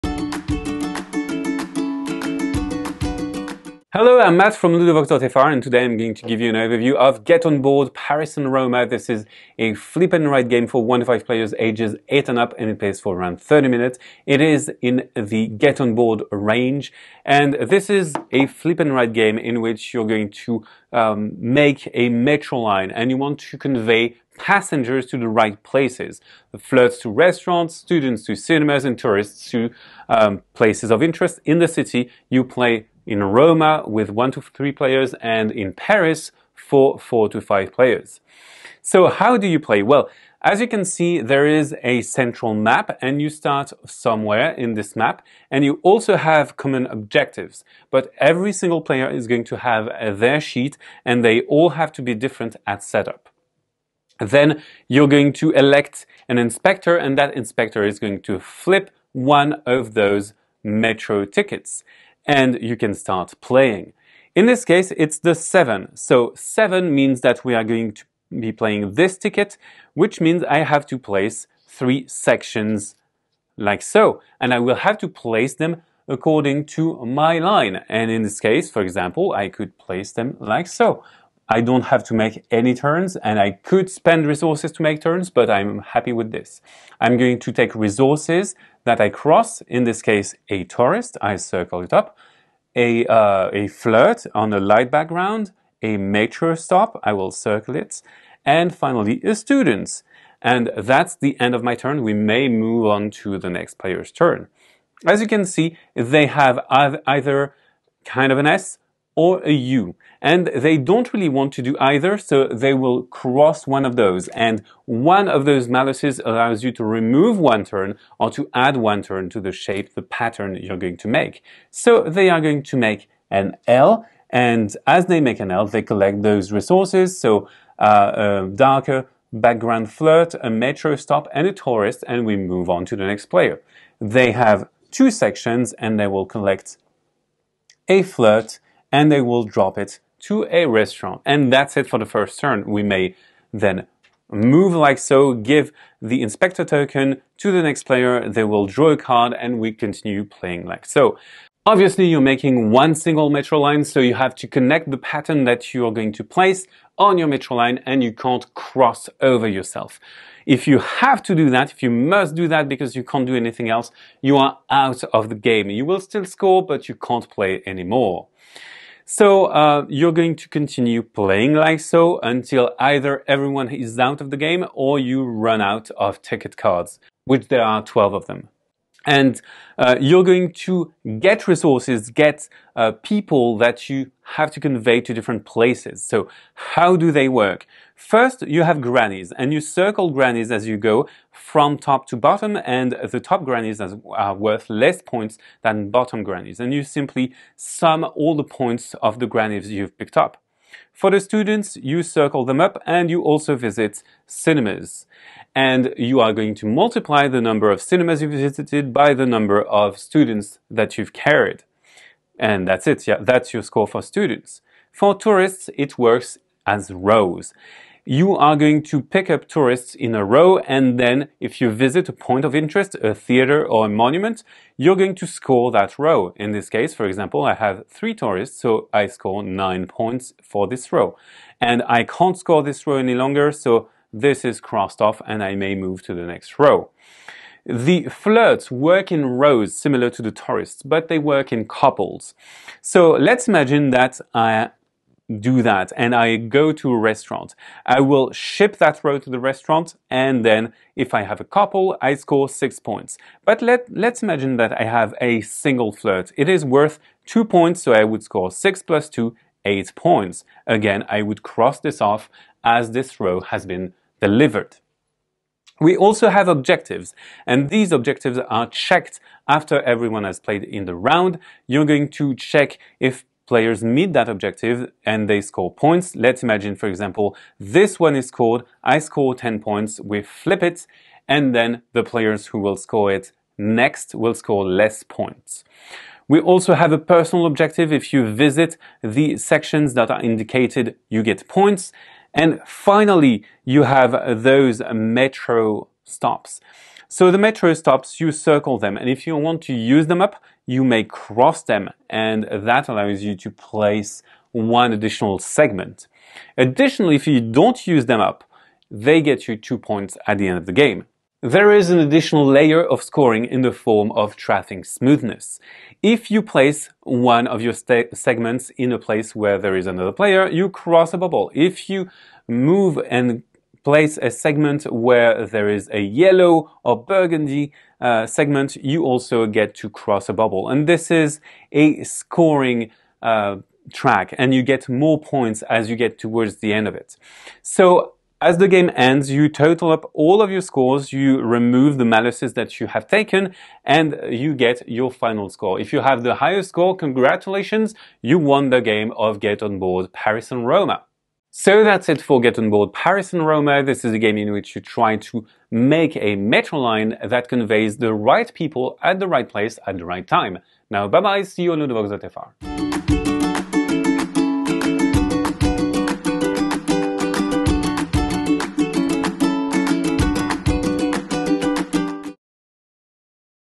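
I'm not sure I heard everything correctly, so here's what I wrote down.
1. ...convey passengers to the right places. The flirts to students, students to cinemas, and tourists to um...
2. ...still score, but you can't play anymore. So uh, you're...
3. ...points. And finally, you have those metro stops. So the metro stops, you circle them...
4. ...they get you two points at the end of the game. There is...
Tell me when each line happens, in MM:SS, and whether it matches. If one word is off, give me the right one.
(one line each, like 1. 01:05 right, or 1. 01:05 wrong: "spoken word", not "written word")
1. 00:23 wrong: "restaurants", not "students"
2. 02:45 right
3. 04:51 right
4. 05:08 right.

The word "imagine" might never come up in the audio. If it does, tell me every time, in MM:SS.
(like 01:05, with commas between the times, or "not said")
04:03, 04:14, 04:36.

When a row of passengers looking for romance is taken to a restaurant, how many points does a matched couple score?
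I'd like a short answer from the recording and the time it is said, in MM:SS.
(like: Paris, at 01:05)
6, at 04:12.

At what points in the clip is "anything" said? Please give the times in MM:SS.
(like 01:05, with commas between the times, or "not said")
02:43.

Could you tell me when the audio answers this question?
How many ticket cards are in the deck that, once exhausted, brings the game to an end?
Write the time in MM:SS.
02:57.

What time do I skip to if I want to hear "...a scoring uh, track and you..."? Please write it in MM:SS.
05:31.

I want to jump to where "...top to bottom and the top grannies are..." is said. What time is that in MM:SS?
03:11.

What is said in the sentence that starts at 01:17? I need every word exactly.
And in this case, for example, I could place them like so.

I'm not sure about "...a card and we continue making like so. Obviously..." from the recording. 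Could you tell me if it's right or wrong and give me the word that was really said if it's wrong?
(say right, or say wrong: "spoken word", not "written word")
wrong: "playing", not "making".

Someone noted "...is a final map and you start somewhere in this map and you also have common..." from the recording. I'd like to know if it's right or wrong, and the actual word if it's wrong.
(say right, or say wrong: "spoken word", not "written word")
wrong: "central", not "final".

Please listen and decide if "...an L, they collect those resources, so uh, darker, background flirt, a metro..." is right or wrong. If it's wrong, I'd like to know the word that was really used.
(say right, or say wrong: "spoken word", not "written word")
right.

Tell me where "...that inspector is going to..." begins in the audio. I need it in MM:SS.
00:57.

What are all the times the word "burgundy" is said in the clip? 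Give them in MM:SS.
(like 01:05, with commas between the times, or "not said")
05:27.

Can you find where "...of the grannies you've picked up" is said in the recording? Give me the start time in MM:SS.
03:19.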